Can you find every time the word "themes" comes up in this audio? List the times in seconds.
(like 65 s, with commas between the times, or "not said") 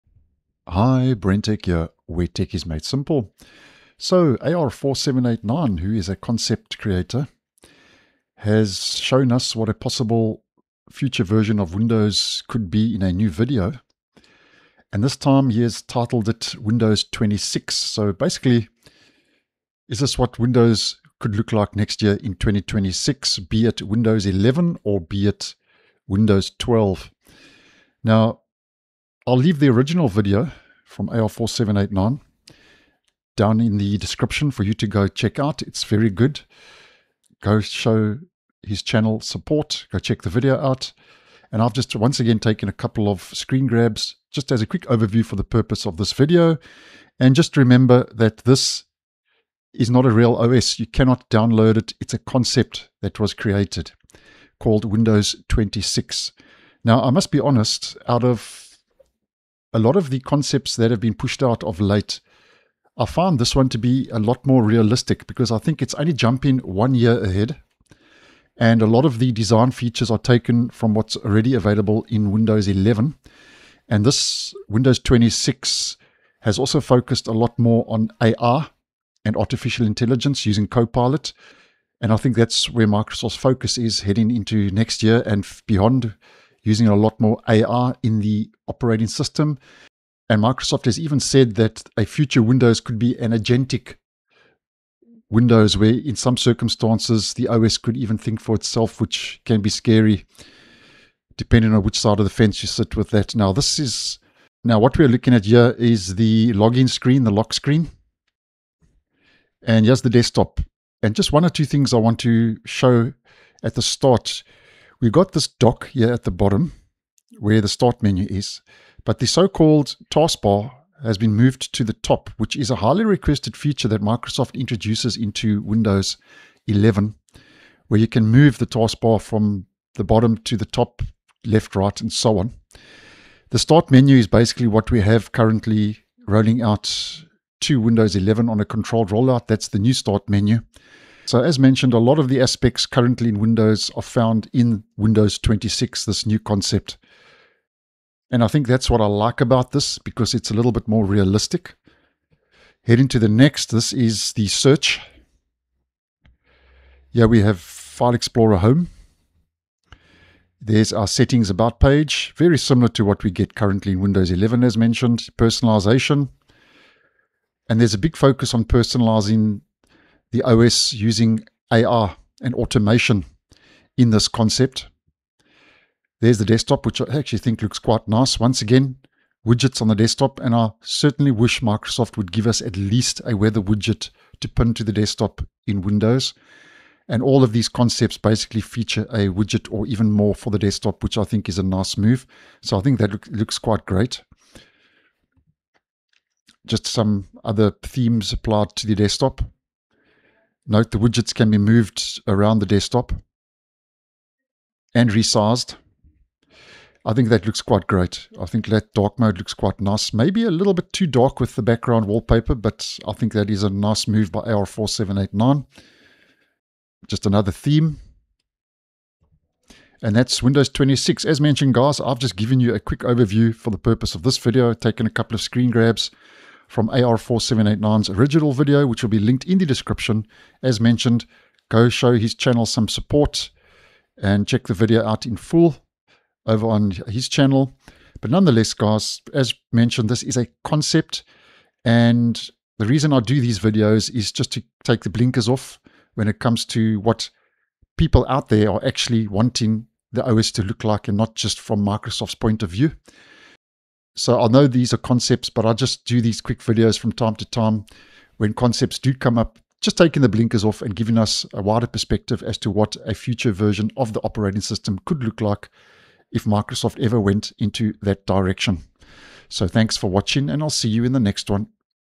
197 s, 217 s.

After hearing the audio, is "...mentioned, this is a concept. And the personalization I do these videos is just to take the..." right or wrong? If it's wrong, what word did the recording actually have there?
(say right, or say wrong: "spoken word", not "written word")
wrong: "reason", not "personalization".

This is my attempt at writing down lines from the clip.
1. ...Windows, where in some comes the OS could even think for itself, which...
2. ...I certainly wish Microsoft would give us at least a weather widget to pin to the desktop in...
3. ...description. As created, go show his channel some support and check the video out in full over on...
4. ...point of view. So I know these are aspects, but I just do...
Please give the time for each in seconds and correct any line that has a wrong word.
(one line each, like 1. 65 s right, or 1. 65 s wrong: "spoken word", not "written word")
1. 95 s wrong: "circumstances", not "comes"
2. 180 s right
3. 229 s wrong: "mentioned", not "created"
4. 252 s wrong: "concepts", not "aspects".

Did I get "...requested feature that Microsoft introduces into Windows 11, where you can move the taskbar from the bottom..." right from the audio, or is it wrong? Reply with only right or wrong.
right.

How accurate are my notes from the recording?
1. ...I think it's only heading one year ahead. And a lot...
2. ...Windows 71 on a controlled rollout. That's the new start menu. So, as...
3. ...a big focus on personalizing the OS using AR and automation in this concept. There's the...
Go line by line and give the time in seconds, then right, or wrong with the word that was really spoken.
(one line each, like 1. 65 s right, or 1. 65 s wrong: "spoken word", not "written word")
1. 65 s wrong: "jumping", not "heading"
2. 137 s wrong: "11", not "71"
3. 167 s right.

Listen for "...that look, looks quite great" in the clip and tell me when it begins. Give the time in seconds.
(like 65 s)
192 s.